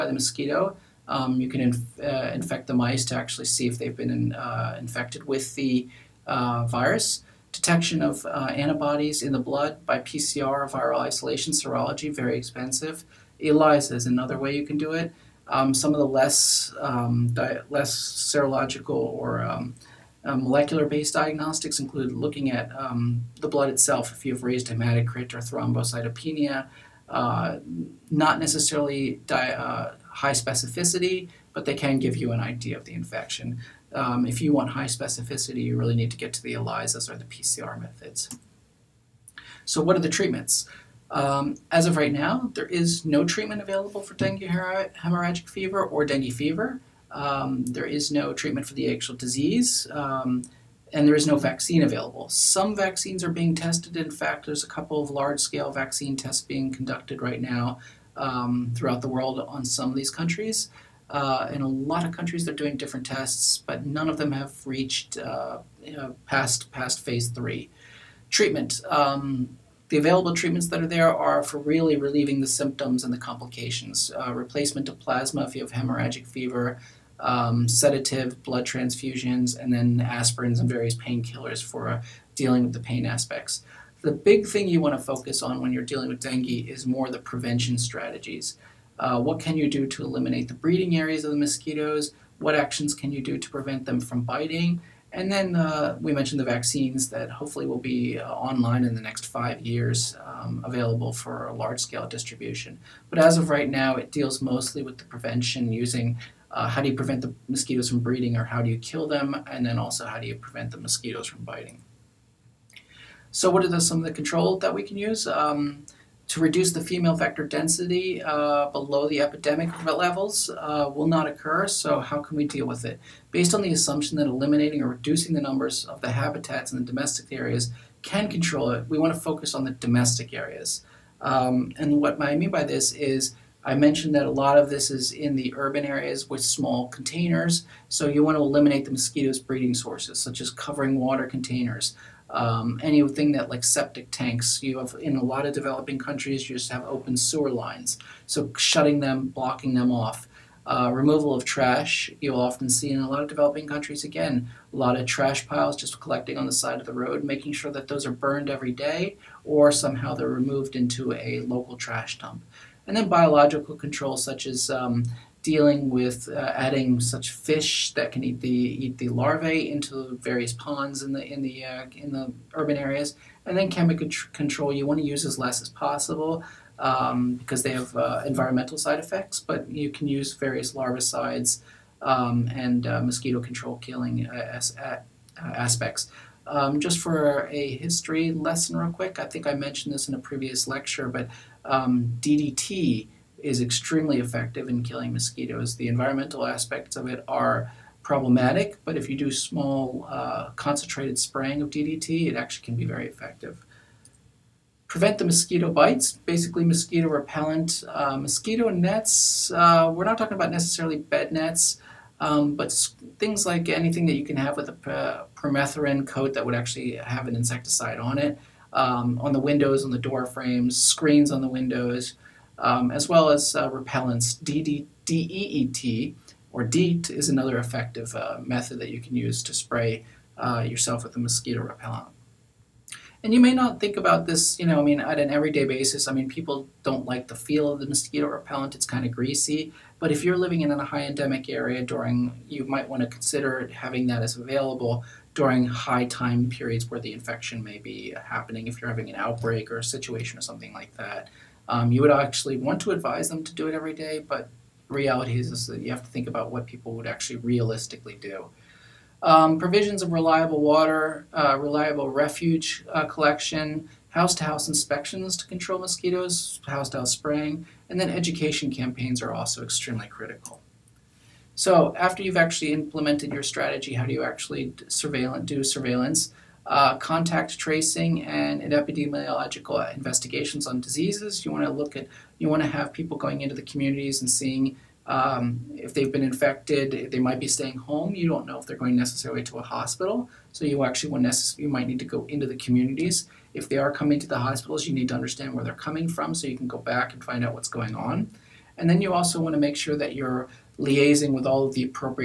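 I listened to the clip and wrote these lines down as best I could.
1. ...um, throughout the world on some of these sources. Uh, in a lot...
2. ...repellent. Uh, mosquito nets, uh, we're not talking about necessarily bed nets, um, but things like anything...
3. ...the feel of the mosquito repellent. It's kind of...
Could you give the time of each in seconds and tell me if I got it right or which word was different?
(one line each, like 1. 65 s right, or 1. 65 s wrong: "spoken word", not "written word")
1. 58 s wrong: "countries", not "sources"
2. 207 s right
3. 237 s right.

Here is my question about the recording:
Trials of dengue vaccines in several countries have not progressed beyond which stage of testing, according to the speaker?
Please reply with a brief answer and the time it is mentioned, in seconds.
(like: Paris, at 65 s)
Phase three, at 67 s.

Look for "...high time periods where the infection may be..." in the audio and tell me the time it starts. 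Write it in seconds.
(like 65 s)
245 s.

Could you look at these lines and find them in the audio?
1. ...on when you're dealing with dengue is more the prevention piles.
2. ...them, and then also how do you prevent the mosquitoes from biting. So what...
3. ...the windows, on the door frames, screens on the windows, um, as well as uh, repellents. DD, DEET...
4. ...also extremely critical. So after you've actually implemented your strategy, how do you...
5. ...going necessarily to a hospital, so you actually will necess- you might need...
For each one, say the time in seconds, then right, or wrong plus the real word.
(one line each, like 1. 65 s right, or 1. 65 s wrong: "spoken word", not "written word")
1. 85 s wrong: "strategies", not "piles"
2. 109 s right
3. 219 s right
4. 269 s right
5. 288 s right.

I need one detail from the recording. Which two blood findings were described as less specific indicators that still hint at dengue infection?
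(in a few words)
Raised hematocrit or thrombocytopenia.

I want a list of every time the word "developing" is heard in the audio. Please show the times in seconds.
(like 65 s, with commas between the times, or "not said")
145 s, 153 s.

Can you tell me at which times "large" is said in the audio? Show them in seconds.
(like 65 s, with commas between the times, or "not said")
55 s, 101 s.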